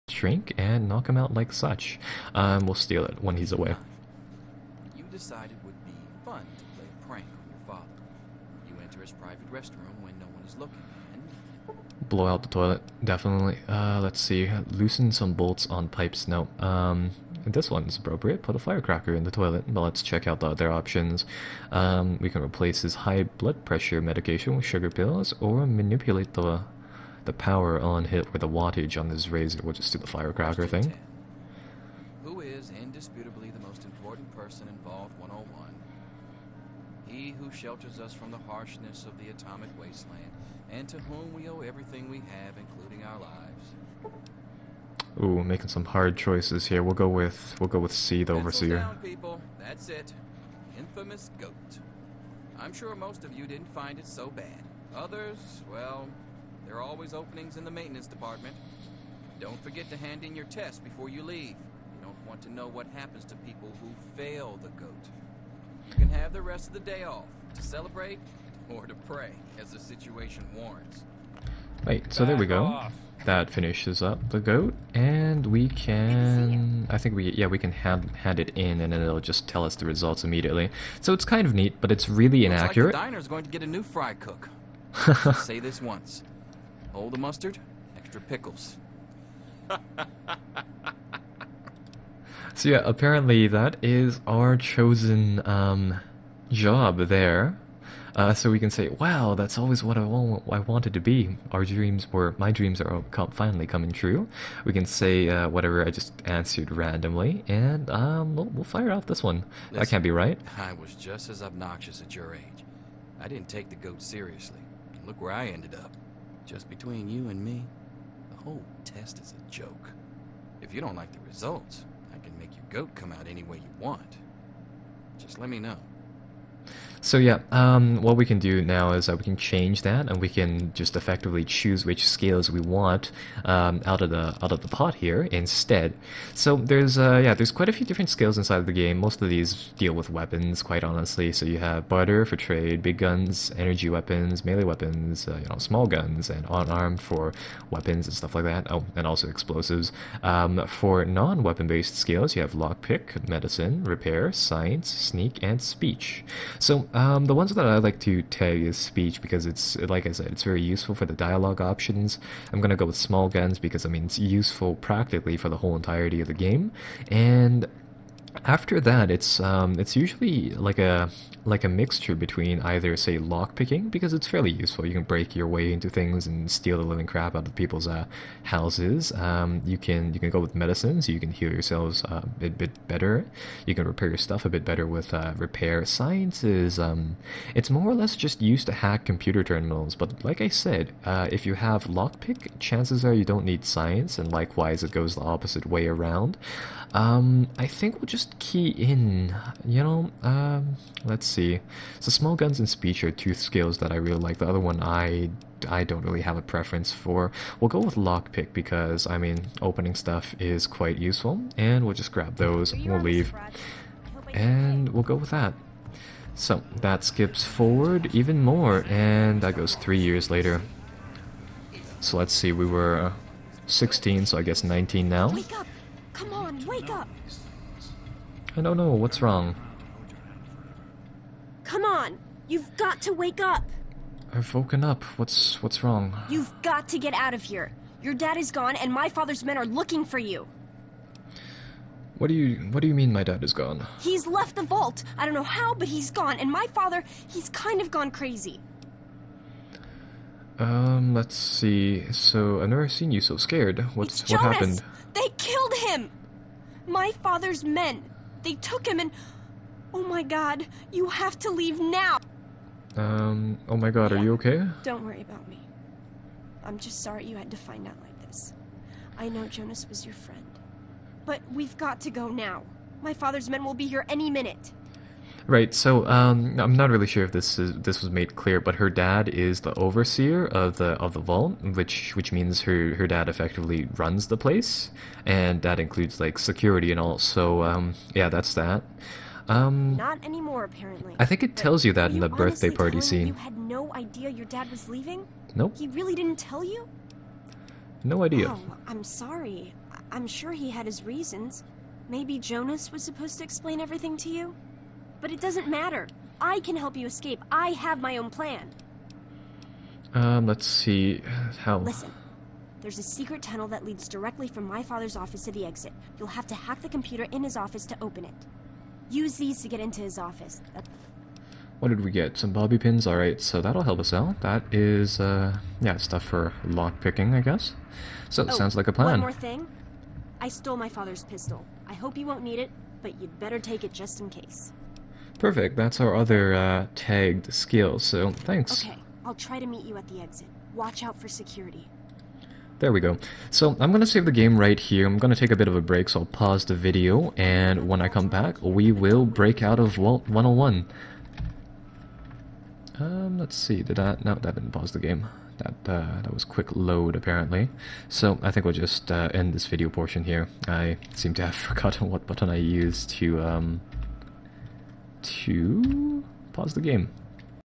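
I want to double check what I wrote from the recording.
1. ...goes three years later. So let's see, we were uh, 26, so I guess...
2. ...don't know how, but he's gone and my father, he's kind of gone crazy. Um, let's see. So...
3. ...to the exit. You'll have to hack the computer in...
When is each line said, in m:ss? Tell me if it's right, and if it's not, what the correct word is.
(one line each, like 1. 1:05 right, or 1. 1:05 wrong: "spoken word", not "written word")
1. 3:39 wrong: "16", not "26"
2. 4:05 right
3. 5:15 right.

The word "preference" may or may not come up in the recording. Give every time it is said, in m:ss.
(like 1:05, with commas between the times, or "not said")
3:26.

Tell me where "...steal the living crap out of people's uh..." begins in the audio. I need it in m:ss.
2:56.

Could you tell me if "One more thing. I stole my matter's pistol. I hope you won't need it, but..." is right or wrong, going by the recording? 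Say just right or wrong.
wrong.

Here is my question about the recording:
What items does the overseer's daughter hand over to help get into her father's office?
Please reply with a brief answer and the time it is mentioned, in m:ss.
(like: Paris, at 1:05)
Bobby pins, at 5:22.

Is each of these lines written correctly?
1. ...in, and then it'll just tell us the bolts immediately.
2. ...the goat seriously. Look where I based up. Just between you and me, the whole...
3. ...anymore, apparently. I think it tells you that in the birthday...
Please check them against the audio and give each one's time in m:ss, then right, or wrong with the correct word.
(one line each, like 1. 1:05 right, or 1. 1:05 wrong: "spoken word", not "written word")
1. 1:18 wrong: "results", not "bolts"
2. 1:53 wrong: "ended", not "based"
3. 4:50 right.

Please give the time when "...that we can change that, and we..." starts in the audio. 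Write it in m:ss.
2:09.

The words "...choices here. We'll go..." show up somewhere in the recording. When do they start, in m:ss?
0:46.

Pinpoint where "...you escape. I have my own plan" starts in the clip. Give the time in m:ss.
5:06.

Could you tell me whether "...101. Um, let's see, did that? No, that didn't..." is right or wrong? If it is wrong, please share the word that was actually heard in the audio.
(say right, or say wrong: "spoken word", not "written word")
right.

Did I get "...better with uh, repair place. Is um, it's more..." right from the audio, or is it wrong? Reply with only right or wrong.
wrong.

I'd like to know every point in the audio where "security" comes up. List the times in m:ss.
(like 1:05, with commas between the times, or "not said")
4:46, 5:41.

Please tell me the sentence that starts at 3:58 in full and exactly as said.
Your dad is gone and my father's men are looking for you.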